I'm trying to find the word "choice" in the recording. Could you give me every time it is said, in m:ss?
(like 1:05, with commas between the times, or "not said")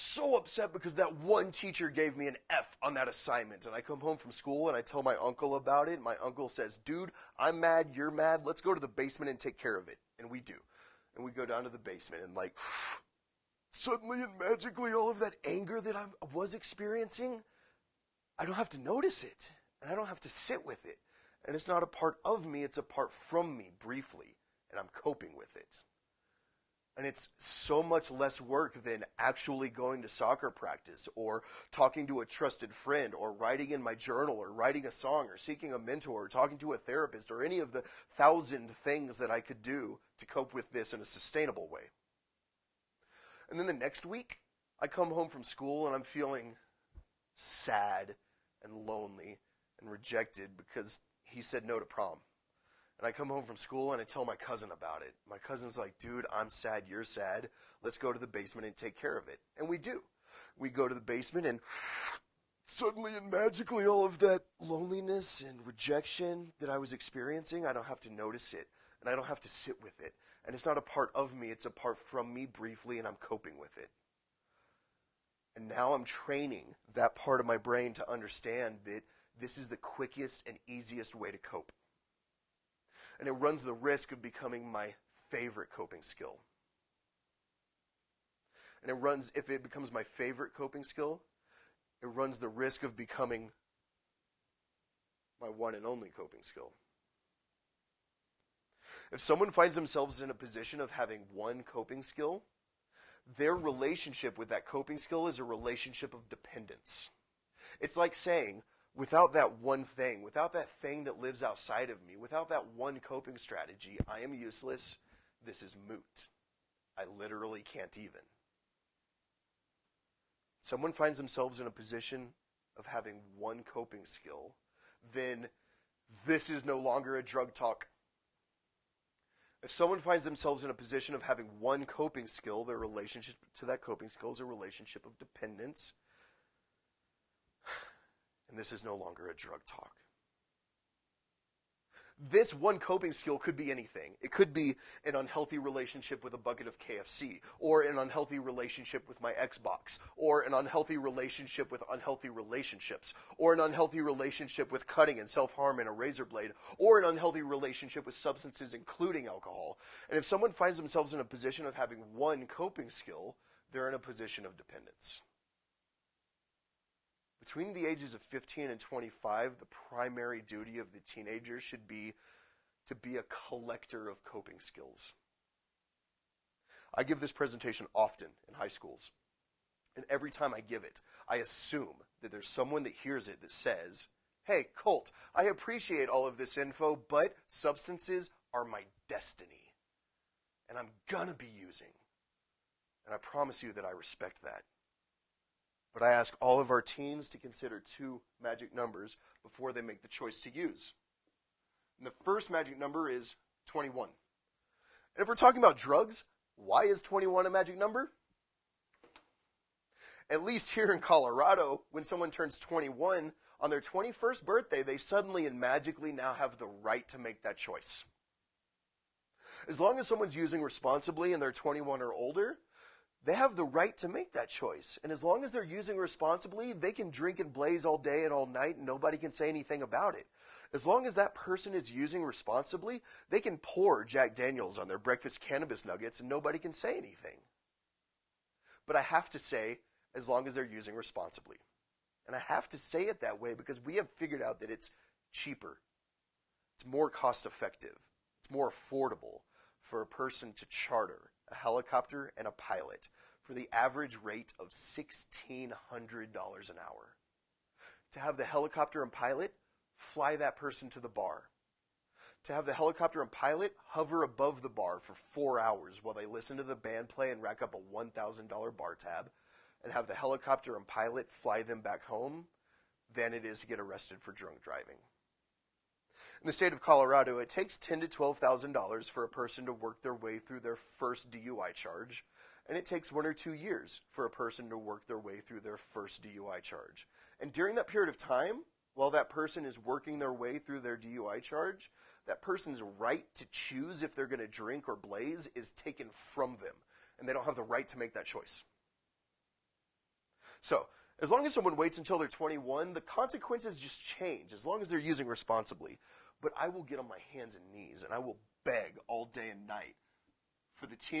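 3:20, 3:37, 3:44, 4:58.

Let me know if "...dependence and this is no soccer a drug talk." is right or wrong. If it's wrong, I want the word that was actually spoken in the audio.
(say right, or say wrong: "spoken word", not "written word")
wrong: "longer", not "soccer".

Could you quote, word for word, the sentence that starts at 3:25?
And if we're talking about drugs, why is 21 a magic number?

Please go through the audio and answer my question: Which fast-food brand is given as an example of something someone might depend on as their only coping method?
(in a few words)
KFC.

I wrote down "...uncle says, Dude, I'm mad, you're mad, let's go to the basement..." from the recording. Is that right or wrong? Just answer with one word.
right.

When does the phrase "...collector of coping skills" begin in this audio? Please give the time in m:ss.
2:53.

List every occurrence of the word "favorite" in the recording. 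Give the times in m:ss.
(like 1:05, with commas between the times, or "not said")
1:25, 1:30.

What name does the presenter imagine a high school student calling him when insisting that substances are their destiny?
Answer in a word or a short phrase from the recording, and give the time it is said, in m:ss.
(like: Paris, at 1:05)
Colt, at 3:04.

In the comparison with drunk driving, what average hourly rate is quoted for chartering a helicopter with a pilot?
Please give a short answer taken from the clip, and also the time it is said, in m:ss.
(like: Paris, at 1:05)
$1,600, at 4:14.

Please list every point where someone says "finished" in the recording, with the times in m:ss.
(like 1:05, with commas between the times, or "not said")
not said.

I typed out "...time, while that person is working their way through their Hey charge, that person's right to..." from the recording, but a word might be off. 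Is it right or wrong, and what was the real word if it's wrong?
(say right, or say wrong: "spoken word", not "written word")
wrong: "DUI", not "Hey".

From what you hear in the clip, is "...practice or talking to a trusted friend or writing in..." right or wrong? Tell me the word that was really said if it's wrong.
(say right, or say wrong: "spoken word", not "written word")
right.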